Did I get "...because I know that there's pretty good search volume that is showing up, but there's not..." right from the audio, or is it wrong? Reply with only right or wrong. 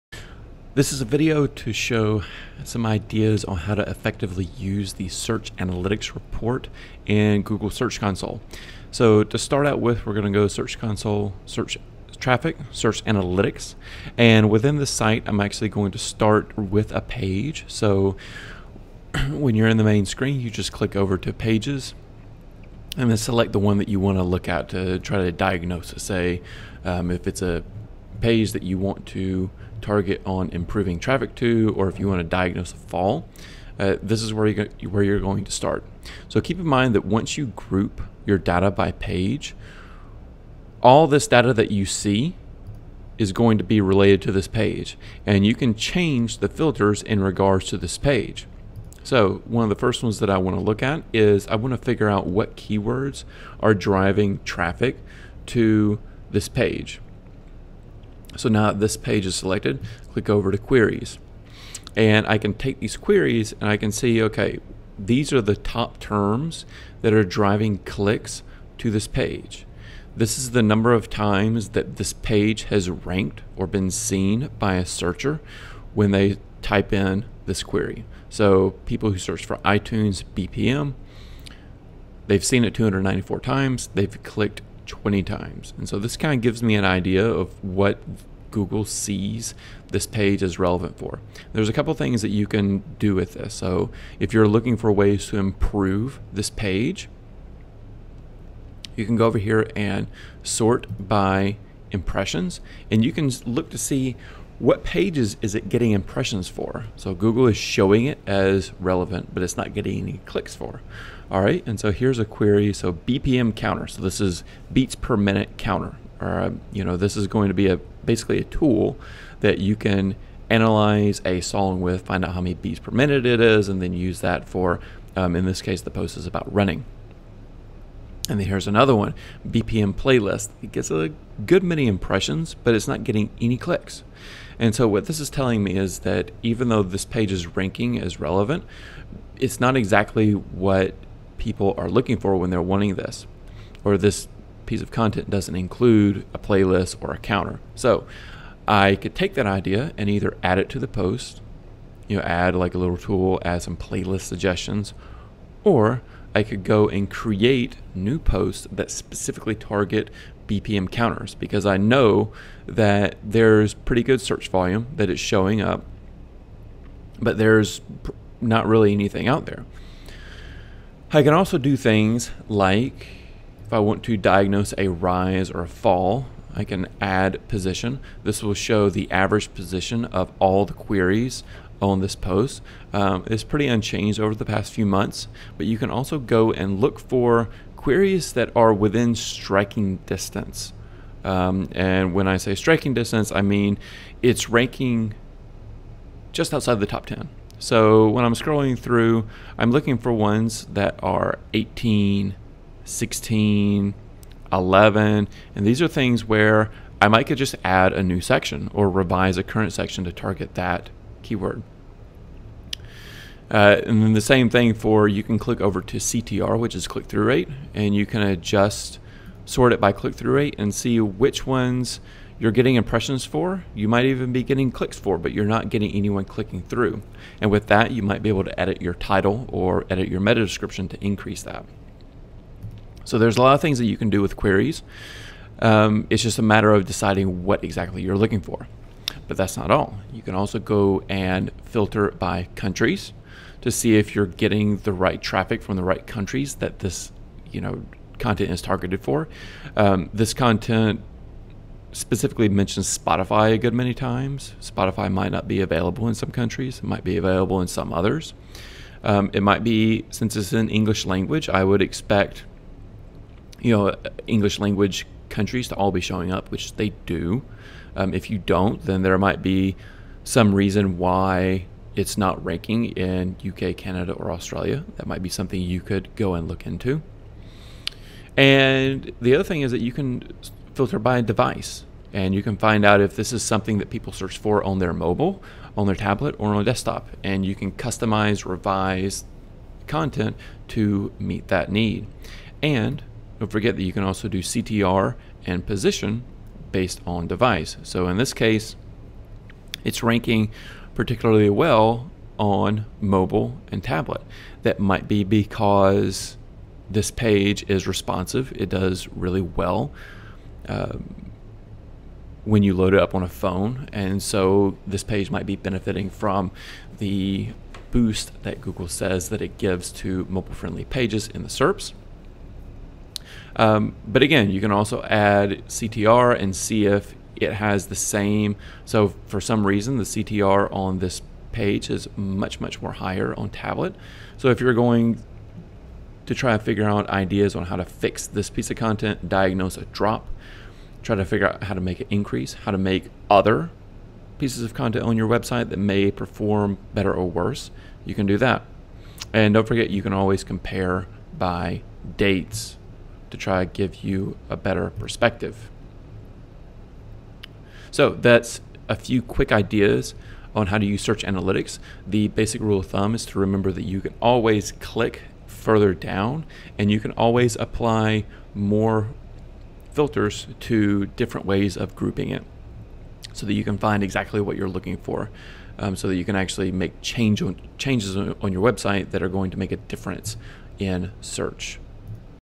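right.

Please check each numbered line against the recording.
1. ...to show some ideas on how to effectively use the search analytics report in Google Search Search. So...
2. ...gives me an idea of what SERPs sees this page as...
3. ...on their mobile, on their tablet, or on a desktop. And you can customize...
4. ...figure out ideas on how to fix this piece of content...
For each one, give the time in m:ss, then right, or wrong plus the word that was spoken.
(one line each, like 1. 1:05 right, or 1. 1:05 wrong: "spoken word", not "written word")
1. 0:01 wrong: "Console", not "Search"
2. 1:26 wrong: "Google", not "SERPs"
3. 4:44 right
4. 5:36 right.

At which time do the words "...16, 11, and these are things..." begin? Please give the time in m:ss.
3:22.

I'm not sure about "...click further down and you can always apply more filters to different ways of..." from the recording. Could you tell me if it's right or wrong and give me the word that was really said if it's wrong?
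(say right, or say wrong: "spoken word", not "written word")
right.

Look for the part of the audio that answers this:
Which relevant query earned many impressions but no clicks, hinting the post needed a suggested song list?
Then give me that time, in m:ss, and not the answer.
2:09.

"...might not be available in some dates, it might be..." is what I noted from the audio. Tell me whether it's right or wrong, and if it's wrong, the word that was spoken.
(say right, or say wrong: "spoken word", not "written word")
wrong: "countries", not "dates".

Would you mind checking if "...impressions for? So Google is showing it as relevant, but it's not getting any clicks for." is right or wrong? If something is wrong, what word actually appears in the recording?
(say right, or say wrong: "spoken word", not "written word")
right.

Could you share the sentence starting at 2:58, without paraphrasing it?
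This will show the average position of all the queries on this post.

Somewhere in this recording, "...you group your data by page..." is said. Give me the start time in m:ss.
0:37.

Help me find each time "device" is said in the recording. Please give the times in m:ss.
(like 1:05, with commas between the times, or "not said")
4:41, 4:57.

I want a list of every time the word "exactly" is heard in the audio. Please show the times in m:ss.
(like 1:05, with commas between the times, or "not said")
2:19, 3:57, 6:14.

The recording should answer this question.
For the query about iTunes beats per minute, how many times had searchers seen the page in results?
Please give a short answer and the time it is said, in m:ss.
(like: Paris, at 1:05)
294, at 1:22.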